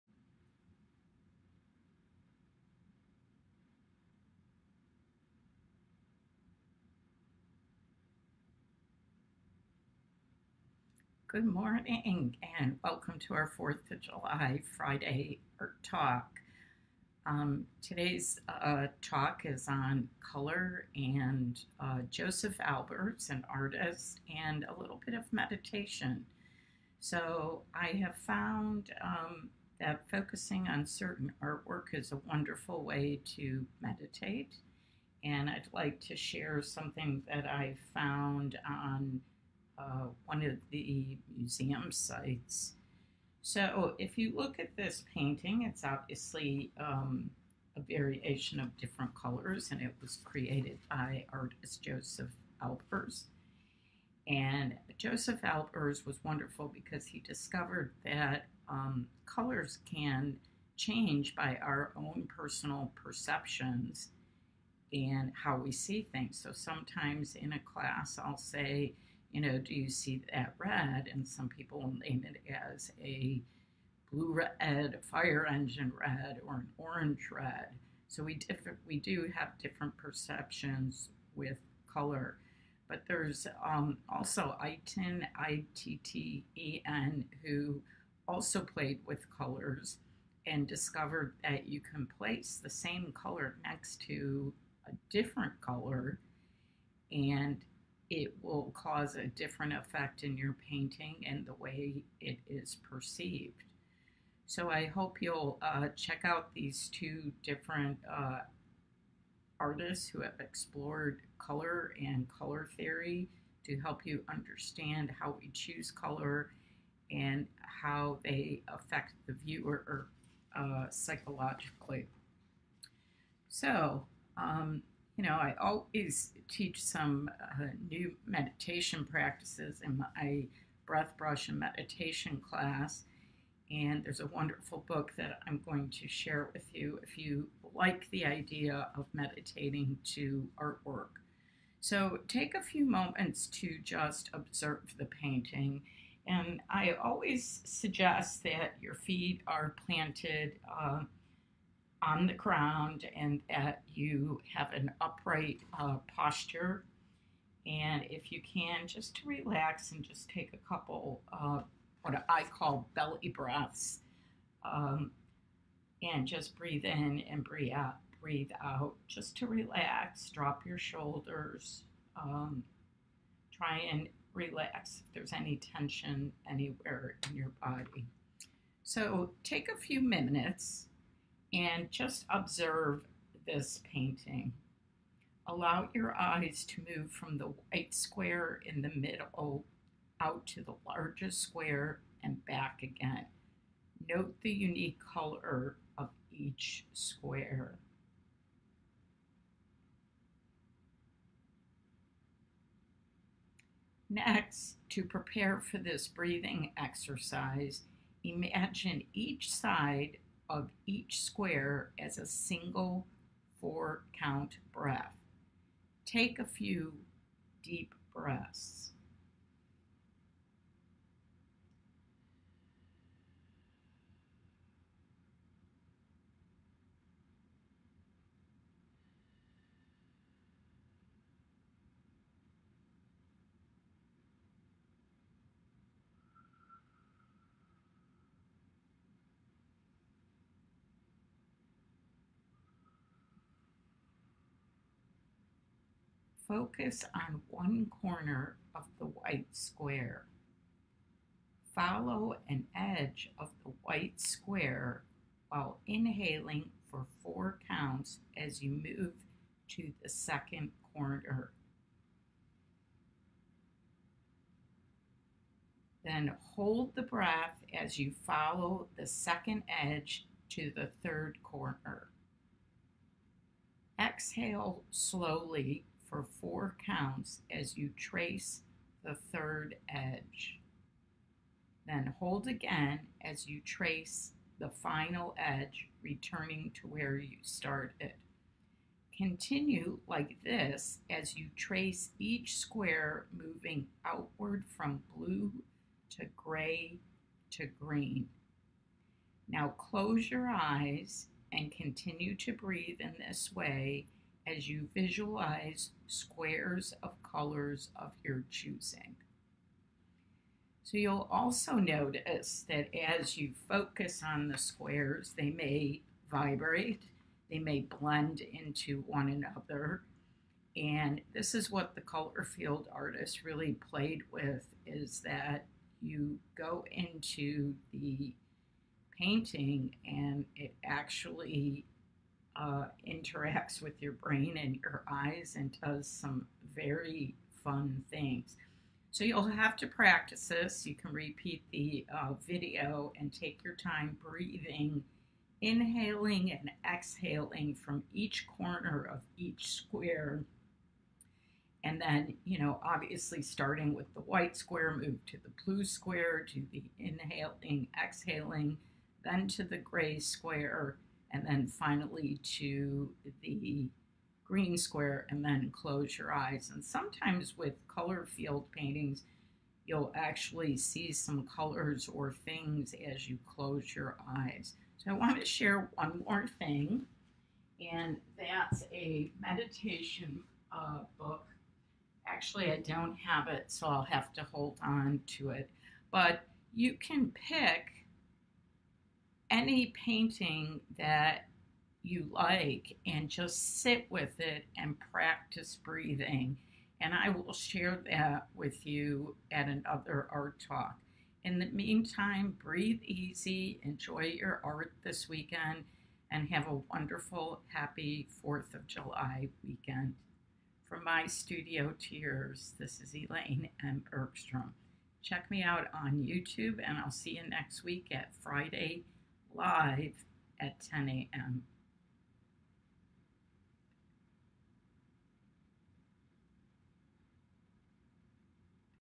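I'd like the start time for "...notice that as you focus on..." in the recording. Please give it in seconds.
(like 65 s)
311 s.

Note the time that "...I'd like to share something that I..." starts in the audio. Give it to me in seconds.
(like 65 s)
35 s.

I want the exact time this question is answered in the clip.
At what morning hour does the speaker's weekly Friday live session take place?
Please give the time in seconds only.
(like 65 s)
420 s.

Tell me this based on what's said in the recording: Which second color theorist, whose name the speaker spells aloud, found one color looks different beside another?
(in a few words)
Itten.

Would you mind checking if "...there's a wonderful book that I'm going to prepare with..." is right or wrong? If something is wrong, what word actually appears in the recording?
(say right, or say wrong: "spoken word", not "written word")
wrong: "share", not "prepare".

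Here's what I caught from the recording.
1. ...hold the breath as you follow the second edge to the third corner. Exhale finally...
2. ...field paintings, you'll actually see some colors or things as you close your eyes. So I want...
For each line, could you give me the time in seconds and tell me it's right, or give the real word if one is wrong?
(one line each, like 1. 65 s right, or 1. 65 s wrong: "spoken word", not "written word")
1. 266 s wrong: "slowly", not "finally"
2. 368 s right.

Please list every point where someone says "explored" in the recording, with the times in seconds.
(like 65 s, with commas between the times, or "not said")
110 s.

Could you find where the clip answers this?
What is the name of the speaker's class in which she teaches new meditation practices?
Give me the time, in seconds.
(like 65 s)
130 s.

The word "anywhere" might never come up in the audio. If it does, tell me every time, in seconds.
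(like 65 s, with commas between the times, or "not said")
176 s.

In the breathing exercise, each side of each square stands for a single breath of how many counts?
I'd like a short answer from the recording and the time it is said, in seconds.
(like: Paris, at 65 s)
4, at 213 s.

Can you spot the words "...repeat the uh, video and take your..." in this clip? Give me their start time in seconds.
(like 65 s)
341 s.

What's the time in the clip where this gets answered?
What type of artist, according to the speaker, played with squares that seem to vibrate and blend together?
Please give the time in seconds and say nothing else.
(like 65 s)
322 s.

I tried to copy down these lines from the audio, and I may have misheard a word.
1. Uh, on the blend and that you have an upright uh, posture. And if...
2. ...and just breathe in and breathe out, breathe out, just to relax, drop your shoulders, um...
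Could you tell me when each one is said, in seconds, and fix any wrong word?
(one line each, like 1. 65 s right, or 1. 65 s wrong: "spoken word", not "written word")
1. 150 s wrong: "ground", not "blend"
2. 166 s right.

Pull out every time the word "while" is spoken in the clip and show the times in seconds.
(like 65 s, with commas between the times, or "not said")
255 s.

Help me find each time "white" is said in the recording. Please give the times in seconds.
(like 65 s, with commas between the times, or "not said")
187 s, 249 s, 253 s, 354 s.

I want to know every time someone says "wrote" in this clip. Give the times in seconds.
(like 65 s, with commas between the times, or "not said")
not said.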